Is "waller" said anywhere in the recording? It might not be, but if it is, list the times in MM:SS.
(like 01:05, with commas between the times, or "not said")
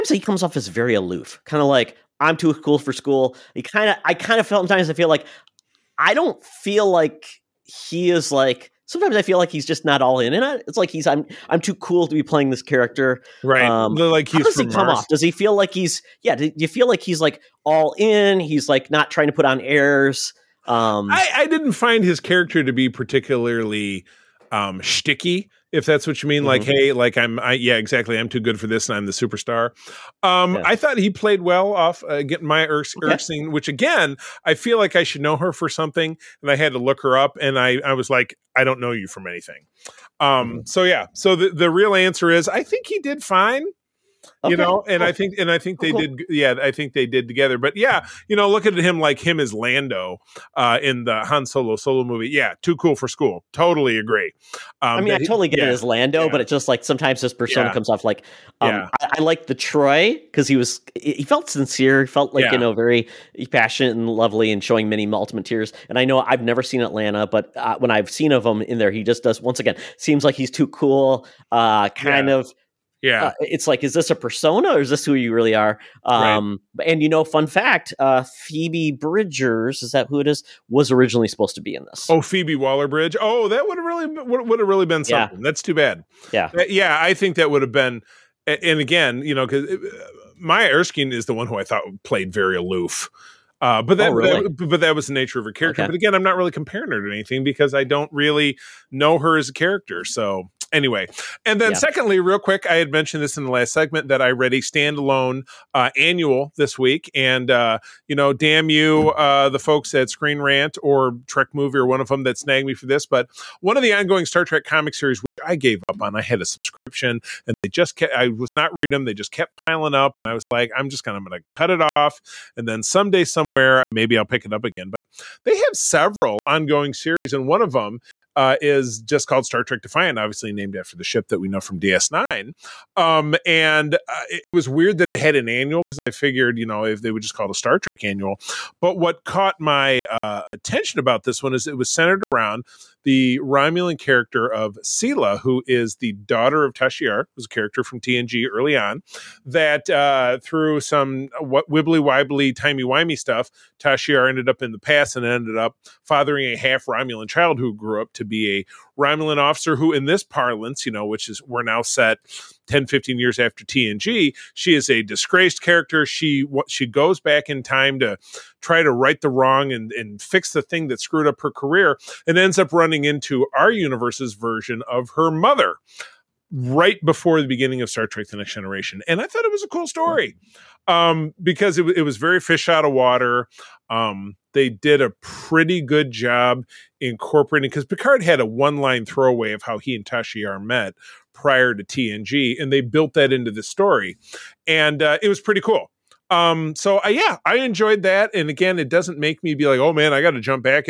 01:22.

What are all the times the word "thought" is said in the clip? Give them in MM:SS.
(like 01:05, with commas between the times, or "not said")
00:30, 01:31, 02:59.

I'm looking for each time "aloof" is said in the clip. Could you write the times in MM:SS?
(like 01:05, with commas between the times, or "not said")
00:00, 01:32.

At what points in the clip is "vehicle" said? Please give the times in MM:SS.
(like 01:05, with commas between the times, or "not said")
not said.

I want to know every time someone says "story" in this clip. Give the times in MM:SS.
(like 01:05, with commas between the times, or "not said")
02:59, 03:13.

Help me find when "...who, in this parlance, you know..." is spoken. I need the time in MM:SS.
02:39.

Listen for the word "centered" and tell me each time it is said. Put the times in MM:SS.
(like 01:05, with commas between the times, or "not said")
02:21.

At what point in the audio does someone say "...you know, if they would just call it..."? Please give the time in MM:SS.
02:16.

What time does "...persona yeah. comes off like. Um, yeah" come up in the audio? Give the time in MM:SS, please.
00:57.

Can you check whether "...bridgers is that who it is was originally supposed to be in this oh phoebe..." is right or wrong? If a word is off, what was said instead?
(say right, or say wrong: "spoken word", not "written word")
right.